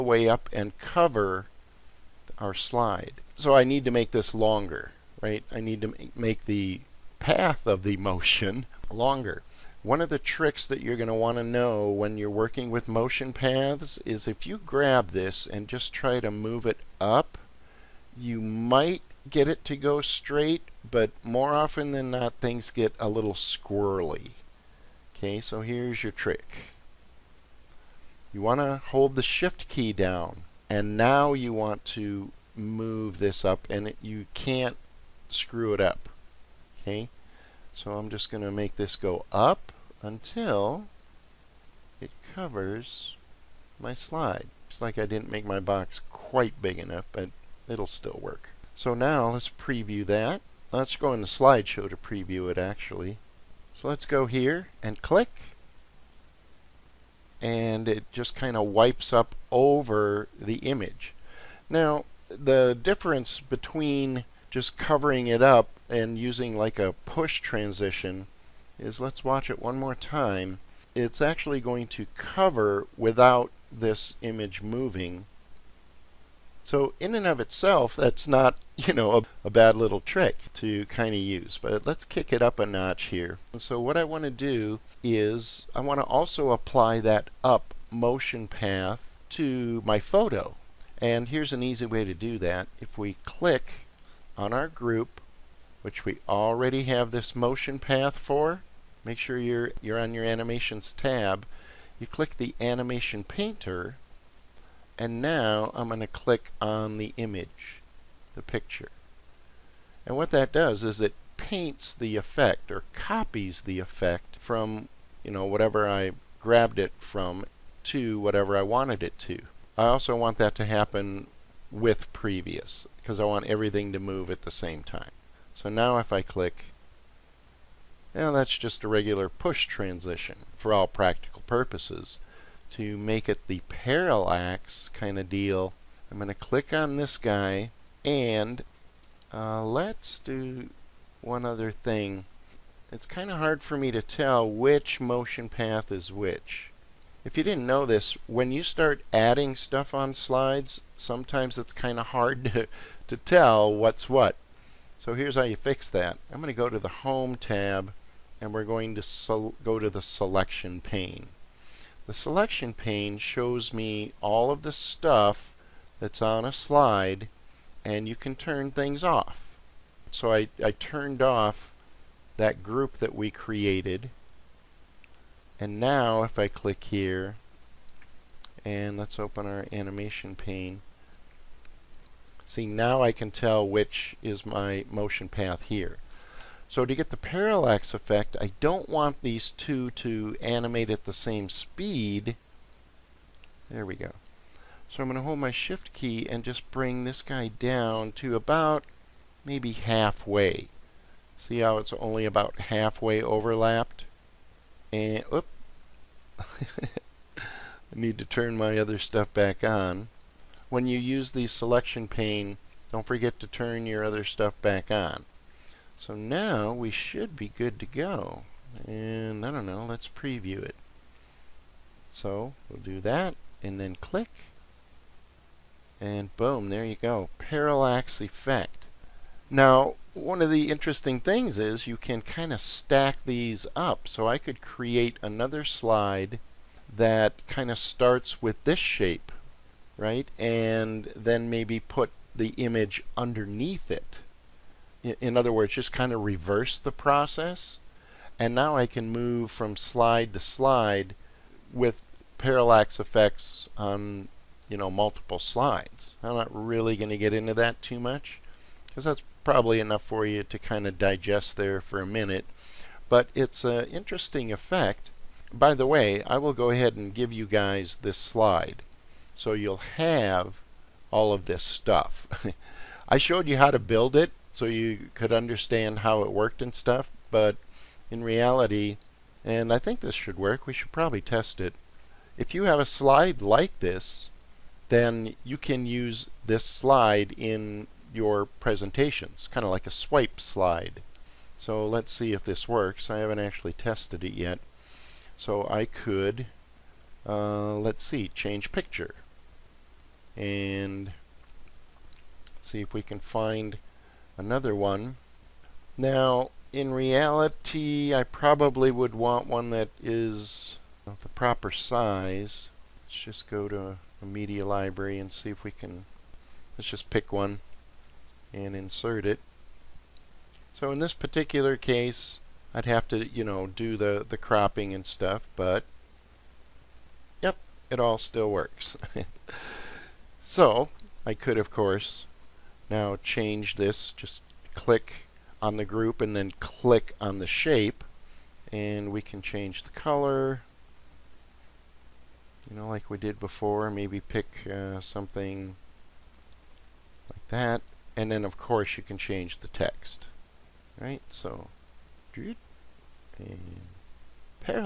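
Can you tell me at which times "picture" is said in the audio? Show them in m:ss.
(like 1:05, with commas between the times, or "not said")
1:48, 4:58.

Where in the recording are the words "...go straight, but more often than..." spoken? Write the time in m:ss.
0:19.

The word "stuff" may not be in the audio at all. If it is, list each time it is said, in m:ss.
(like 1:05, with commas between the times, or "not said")
2:29, 2:44, 3:28, 3:34, 4:31, 4:36, 5:25.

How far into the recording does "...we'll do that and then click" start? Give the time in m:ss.
3:42.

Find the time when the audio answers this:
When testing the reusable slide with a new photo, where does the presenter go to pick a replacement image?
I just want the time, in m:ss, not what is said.
5:14.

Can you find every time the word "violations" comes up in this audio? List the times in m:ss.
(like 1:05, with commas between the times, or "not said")
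not said.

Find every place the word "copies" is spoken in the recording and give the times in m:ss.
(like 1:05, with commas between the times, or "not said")
1:52.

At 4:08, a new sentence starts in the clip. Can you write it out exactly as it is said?
And now I can move from slide to slide with parallax effects on, you know, multiple slides.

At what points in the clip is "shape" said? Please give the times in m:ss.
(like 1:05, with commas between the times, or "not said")
3:58, 5:37.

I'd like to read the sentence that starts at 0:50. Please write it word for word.
Let's go into slideshow to preview it actually.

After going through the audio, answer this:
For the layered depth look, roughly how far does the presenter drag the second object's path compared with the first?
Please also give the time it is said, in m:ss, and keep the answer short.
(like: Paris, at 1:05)
about halfway, at 3:18.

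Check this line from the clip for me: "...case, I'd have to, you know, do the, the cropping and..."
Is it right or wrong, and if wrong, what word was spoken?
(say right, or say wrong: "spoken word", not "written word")
right.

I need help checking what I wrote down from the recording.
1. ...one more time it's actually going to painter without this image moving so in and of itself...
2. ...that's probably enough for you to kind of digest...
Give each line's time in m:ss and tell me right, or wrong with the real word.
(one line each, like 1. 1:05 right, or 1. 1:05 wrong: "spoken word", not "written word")
1. 1:09 wrong: "cover", not "painter"
2. 4:19 right.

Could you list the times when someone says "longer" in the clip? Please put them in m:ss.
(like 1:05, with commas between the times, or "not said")
0:04, 0:08.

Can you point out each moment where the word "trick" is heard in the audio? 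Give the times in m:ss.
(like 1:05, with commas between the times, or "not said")
0:10, 0:26, 1:19.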